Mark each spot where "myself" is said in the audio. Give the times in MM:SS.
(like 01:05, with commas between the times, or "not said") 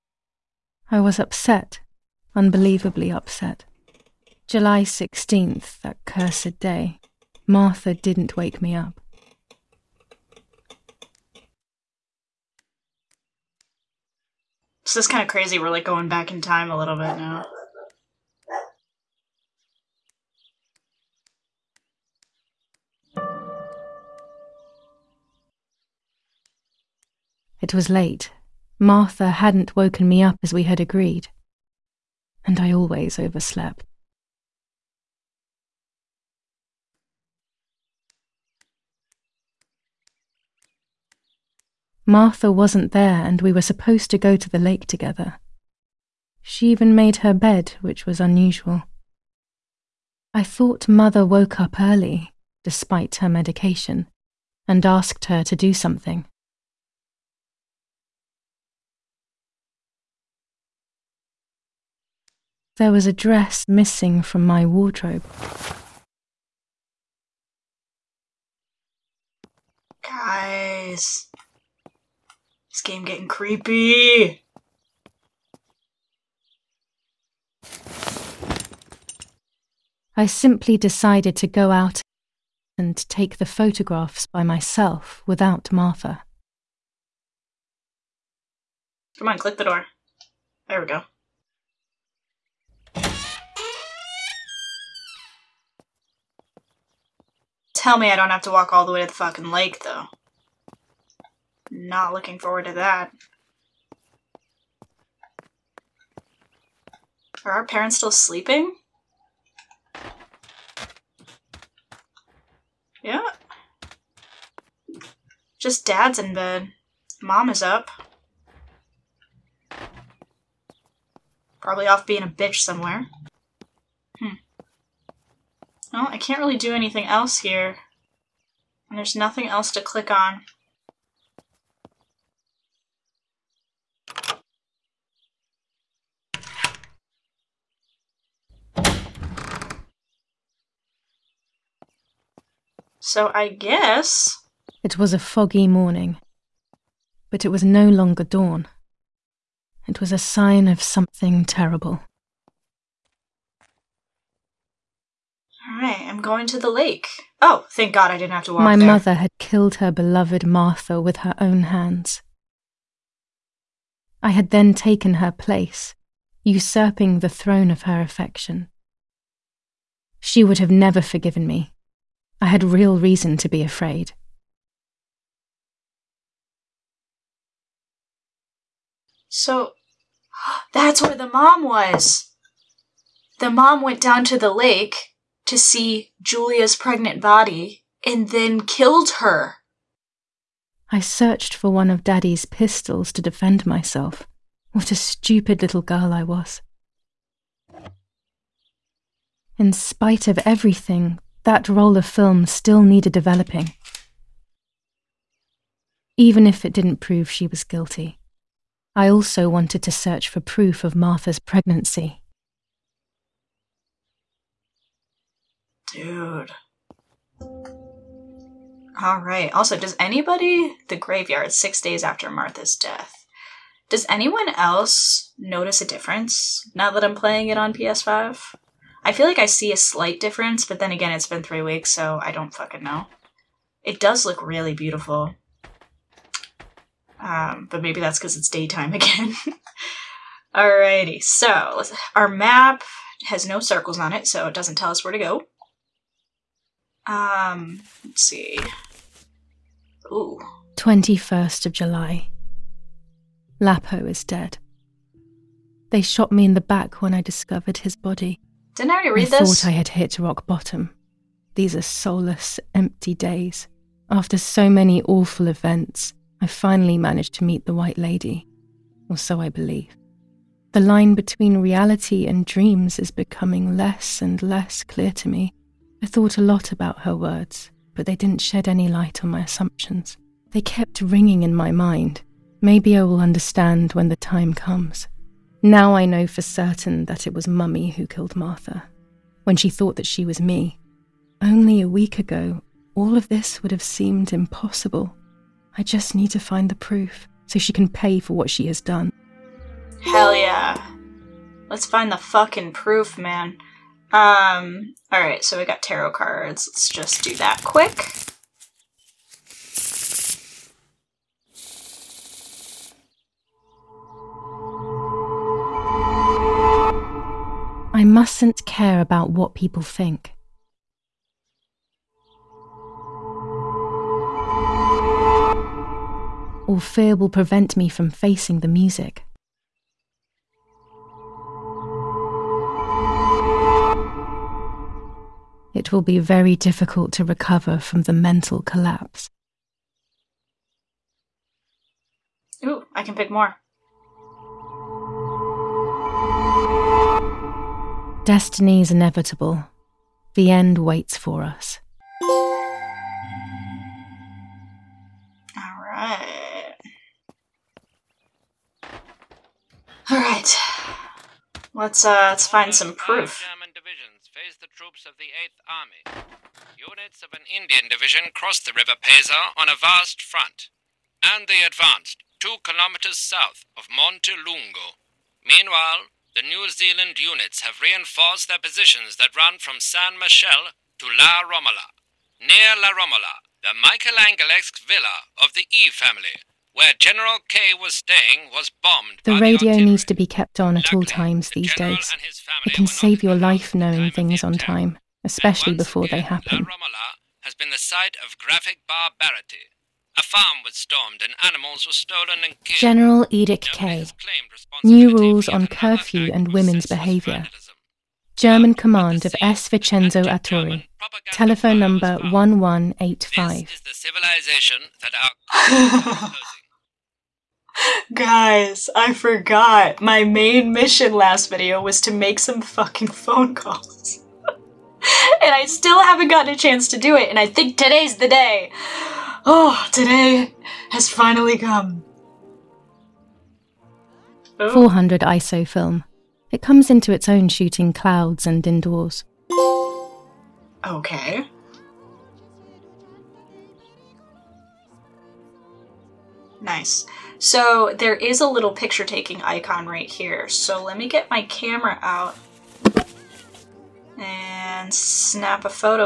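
01:24, 03:13.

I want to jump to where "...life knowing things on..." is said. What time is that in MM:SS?
06:33.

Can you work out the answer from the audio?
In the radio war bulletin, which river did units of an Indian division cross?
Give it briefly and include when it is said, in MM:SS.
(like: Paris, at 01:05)
River Pesa, at 06:08.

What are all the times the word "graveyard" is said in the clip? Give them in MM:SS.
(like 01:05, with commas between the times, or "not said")
03:40.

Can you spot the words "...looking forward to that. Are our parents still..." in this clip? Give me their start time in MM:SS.
01:42.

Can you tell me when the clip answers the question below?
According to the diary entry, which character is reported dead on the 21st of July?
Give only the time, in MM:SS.
04:13.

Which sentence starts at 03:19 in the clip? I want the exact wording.
In spite of everything, that roll of film still needed developing.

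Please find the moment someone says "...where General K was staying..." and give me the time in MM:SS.
06:26.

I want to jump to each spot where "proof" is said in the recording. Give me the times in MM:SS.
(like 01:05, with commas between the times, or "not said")
03:30, 04:56, 05:02, 06:02.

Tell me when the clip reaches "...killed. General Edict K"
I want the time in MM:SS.
06:42.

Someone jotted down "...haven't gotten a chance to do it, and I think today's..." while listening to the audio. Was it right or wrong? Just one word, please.
right.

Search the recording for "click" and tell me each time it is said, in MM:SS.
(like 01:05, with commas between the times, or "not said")
01:29, 02:09.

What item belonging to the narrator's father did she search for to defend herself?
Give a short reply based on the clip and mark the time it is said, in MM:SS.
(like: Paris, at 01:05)
pistols, at 03:12.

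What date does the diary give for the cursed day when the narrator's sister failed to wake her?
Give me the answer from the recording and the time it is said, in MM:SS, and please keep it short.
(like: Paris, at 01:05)
July 16, at 00:04.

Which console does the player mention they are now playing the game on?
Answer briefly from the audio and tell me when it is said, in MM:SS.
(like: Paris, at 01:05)
PS5, at 03:47.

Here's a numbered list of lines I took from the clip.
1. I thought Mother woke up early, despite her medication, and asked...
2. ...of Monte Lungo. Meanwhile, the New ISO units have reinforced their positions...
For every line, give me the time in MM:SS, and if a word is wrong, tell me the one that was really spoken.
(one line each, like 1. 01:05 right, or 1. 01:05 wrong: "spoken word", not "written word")
1. 00:50 right
2. 06:13 wrong: "Zealand", not "ISO".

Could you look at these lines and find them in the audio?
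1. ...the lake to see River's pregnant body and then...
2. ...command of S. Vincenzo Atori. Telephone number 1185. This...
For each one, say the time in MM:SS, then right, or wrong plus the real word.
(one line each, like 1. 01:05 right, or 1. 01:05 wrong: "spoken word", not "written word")
1. 03:04 wrong: "Julia", not "River"
2. 06:48 right.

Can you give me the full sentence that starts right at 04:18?
Didn't I already read I this?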